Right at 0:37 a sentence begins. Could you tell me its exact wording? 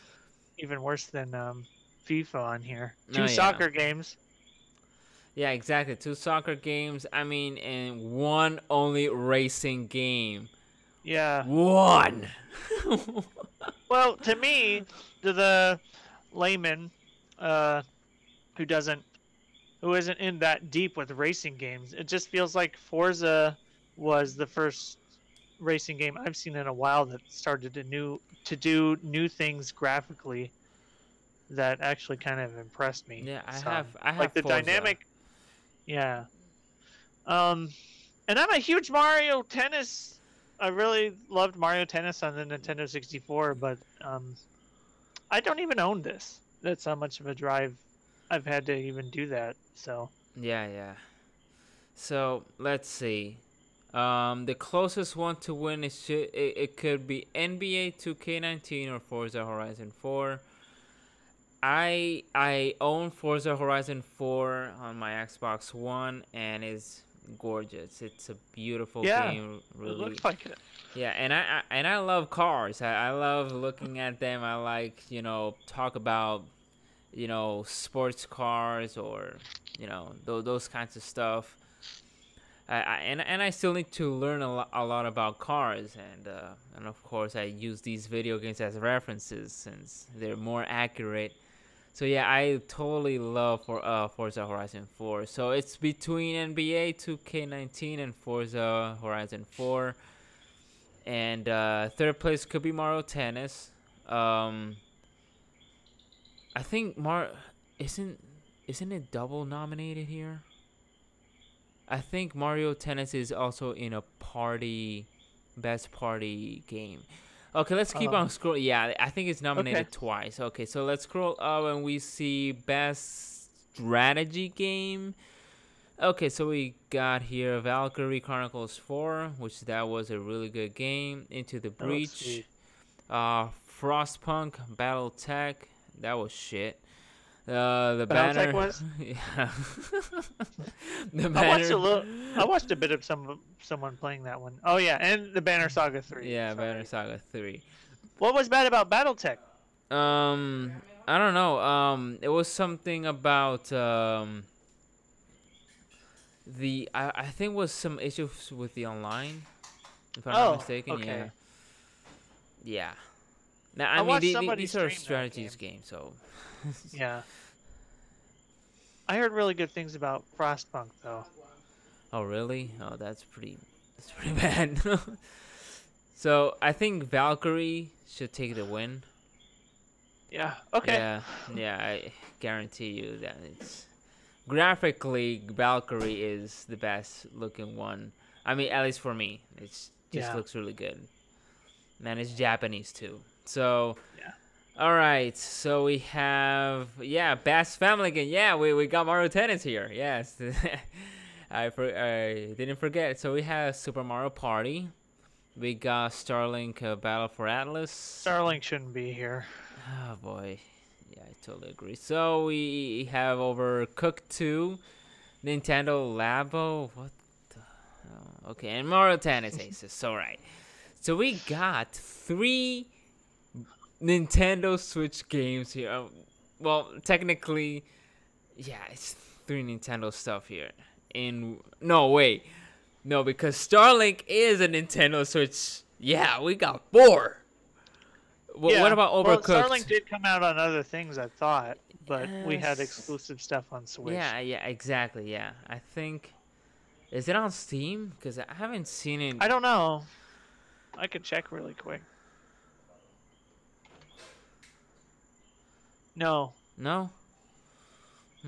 Um, and I'm a huge Mario Tennis.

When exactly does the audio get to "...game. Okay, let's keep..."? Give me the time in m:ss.
1:56.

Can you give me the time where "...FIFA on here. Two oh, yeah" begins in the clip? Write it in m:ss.
0:02.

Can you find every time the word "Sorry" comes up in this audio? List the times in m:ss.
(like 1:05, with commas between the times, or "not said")
2:26.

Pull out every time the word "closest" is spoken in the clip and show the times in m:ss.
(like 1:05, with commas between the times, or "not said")
0:54.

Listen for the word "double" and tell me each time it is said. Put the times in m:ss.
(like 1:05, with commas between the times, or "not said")
1:49.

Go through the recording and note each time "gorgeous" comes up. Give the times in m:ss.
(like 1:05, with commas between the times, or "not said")
1:07.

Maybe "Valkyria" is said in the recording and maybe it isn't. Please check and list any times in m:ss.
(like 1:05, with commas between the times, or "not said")
2:07, 2:57, 3:05.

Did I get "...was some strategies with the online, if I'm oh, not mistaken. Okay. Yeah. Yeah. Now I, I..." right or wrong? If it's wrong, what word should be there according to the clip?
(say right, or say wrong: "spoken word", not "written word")
wrong: "issues", not "strategies".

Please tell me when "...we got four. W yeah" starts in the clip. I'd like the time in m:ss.
3:56.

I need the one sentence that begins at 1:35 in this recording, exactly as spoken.
So it's between NBA 2K19 and Forza Horizon 4.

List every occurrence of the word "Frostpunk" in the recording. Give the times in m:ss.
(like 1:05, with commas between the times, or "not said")
2:13, 2:50.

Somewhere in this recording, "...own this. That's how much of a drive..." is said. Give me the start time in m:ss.
0:45.